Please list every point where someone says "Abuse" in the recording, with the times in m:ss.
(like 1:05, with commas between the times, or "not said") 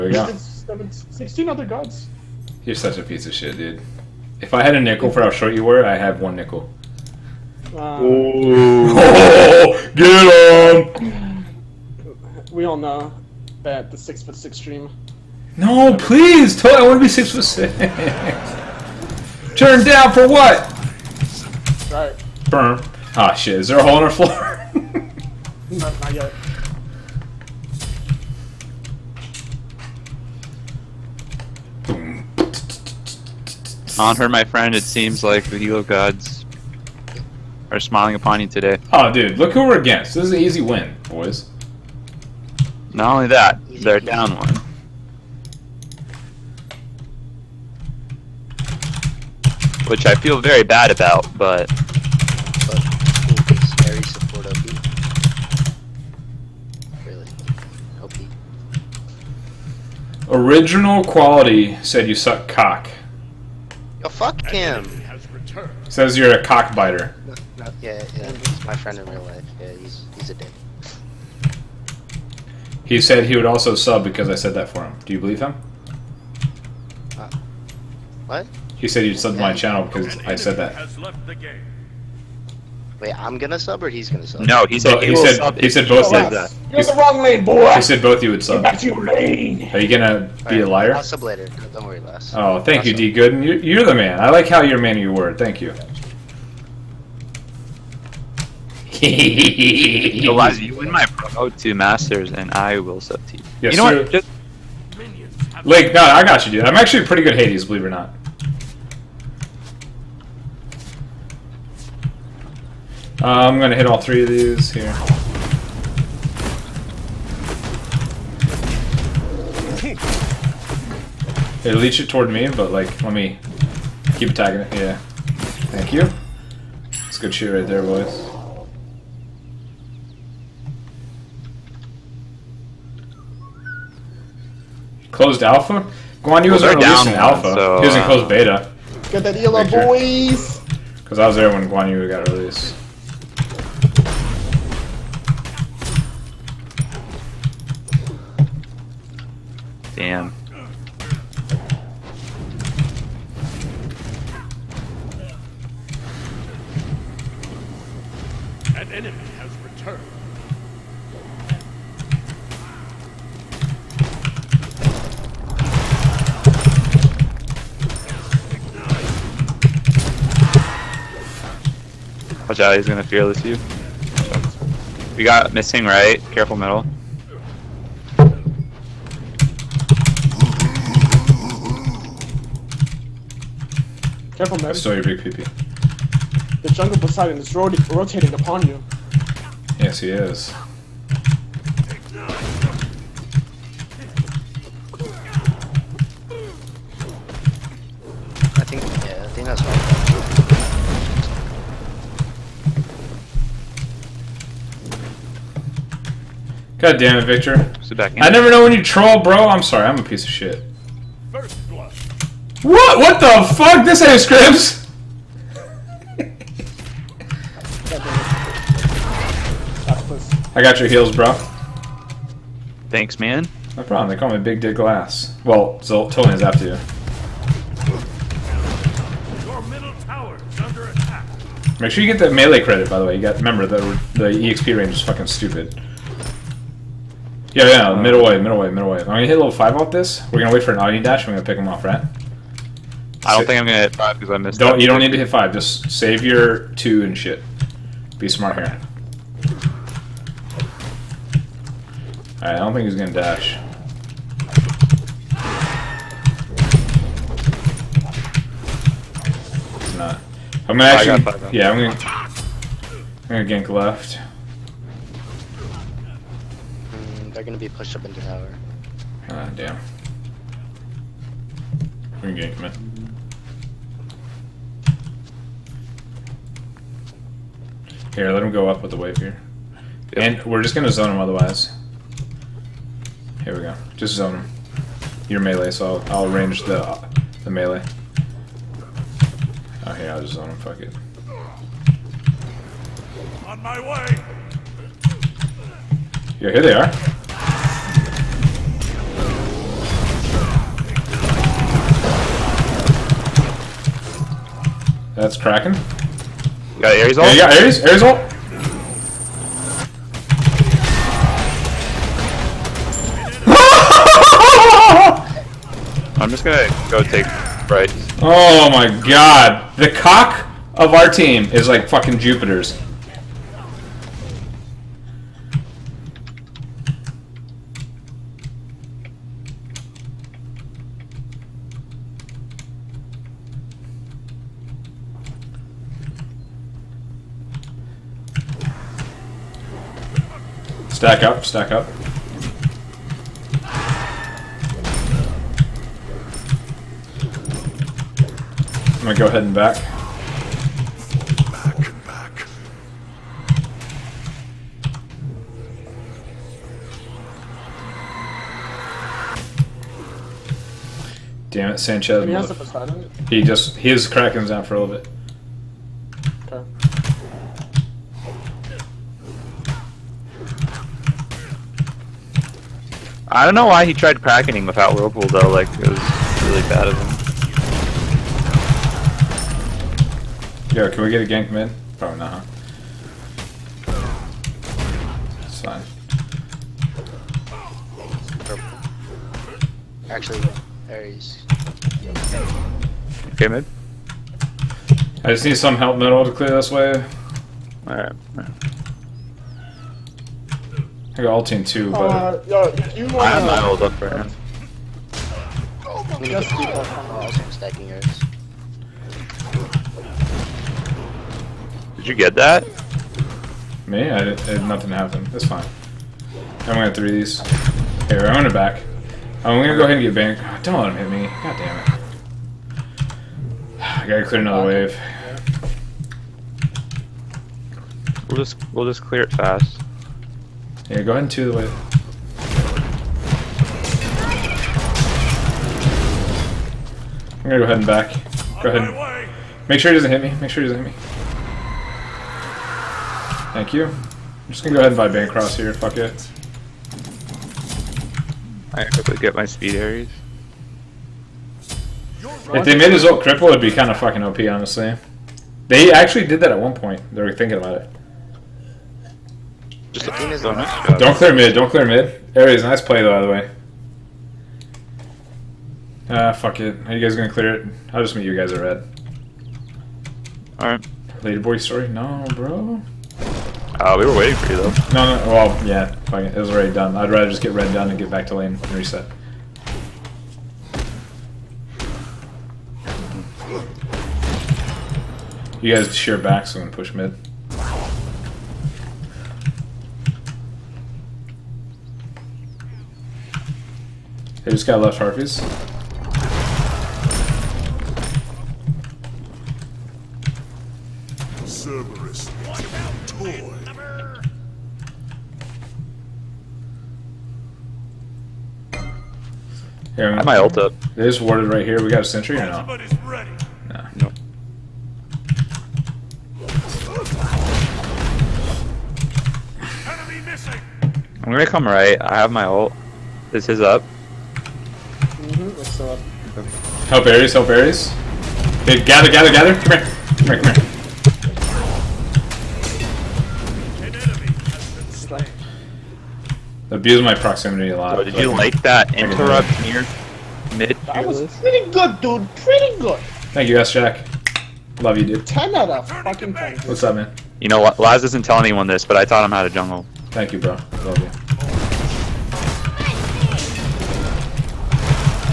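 8:56.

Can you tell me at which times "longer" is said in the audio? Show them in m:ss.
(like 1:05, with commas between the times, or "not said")
not said.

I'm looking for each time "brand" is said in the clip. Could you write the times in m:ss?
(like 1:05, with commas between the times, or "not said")
not said.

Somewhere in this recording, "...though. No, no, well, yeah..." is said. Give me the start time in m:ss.
7:54.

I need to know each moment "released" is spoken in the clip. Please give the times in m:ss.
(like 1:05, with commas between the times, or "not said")
2:16, 2:22.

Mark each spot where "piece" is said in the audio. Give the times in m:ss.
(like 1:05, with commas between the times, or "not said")
0:03, 3:30.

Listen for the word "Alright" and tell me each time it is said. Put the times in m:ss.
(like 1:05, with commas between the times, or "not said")
6:37, 7:50.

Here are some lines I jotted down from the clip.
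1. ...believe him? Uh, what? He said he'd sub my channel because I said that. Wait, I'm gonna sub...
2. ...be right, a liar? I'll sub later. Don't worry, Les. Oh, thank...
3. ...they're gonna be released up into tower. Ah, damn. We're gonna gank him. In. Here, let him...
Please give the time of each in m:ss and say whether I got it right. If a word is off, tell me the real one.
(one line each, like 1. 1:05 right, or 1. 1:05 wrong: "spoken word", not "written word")
1. 1:15 right
2. 1:30 right
3. 4:27 wrong: "pushed", not "released".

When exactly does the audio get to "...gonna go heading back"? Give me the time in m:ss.
5:49.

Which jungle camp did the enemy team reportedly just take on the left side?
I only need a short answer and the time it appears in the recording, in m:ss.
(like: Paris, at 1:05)
Harpies, at 8:14.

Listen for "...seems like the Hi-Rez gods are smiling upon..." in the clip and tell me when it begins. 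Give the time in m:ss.
0:34.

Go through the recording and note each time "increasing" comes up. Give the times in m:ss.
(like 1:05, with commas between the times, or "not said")
not said.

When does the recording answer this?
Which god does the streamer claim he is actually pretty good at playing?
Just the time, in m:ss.
1:47.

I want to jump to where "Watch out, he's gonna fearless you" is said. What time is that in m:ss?
2:52.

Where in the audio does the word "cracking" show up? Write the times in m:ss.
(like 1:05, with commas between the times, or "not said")
6:04, 6:14.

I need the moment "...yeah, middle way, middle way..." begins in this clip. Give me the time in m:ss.
3:57.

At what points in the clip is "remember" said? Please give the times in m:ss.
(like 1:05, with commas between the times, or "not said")
3:53.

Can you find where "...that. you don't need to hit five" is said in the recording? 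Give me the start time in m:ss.
4:04.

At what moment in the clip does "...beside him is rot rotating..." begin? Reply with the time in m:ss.
3:06.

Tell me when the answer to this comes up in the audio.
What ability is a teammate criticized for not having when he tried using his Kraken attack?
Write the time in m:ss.
6:14.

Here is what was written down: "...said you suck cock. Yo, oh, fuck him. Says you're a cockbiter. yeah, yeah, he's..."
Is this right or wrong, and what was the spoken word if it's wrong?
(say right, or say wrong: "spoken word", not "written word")
right.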